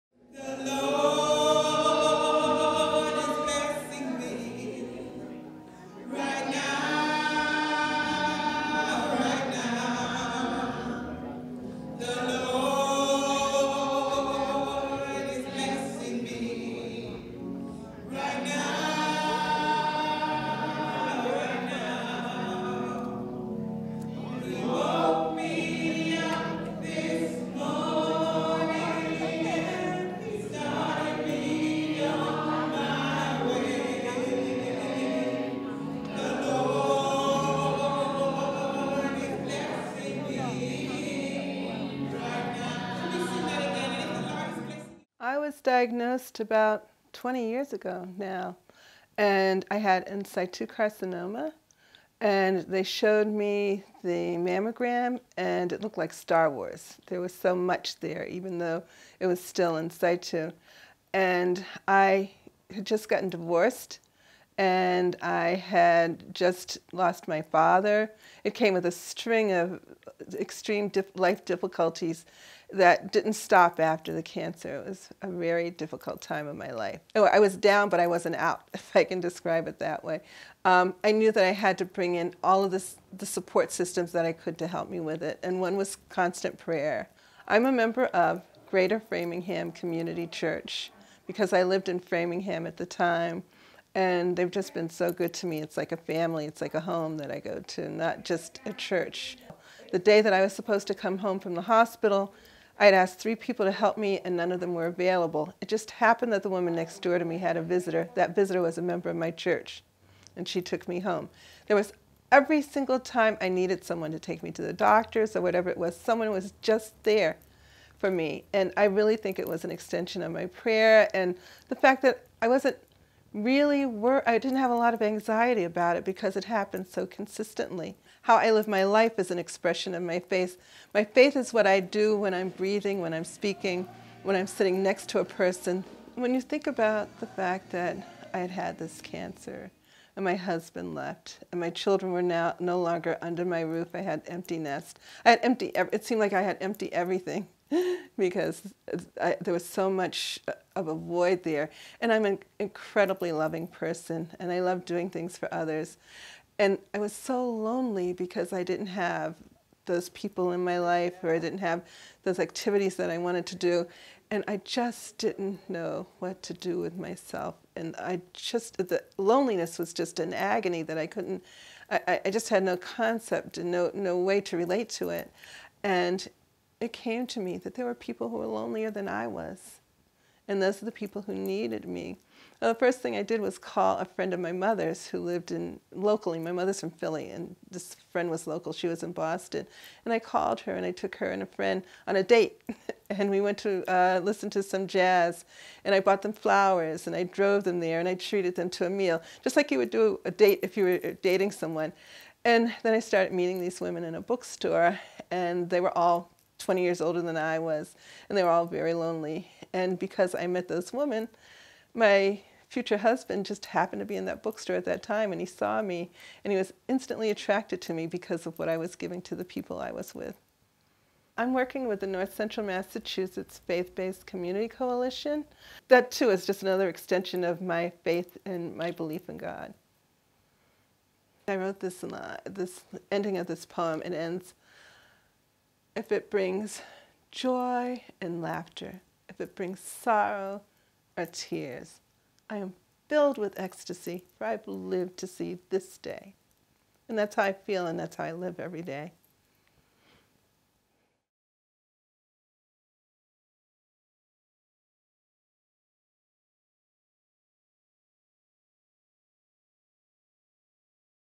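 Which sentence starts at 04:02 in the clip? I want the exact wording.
I am filled with ecstasy, for I've lived to see this day.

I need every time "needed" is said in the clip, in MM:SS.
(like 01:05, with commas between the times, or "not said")
01:53, 03:01.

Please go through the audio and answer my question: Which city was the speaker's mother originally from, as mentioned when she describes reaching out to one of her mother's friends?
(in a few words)
Philly.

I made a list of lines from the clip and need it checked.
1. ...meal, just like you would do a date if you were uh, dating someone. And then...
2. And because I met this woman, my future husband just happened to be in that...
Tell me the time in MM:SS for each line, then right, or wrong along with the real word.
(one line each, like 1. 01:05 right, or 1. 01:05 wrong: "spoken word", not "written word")
1. 03:18 right
2. 03:29 right.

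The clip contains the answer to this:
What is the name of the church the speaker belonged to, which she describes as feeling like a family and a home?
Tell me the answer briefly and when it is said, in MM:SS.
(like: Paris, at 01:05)
Greater Framingham Community Church, at 01:28.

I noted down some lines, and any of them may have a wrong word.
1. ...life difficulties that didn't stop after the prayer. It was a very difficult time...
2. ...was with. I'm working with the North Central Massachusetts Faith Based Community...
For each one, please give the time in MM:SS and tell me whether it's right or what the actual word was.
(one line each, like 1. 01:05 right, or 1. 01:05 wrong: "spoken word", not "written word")
1. 01:11 wrong: "cancer", not "prayer"
2. 03:39 right.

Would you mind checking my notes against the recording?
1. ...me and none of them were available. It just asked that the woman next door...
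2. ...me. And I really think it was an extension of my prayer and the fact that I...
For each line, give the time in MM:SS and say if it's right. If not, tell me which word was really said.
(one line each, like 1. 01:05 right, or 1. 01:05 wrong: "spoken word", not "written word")
1. 01:43 wrong: "happened", not "asked"
2. 01:58 right.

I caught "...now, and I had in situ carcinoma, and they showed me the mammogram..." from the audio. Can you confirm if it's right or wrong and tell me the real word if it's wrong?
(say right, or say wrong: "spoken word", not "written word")
right.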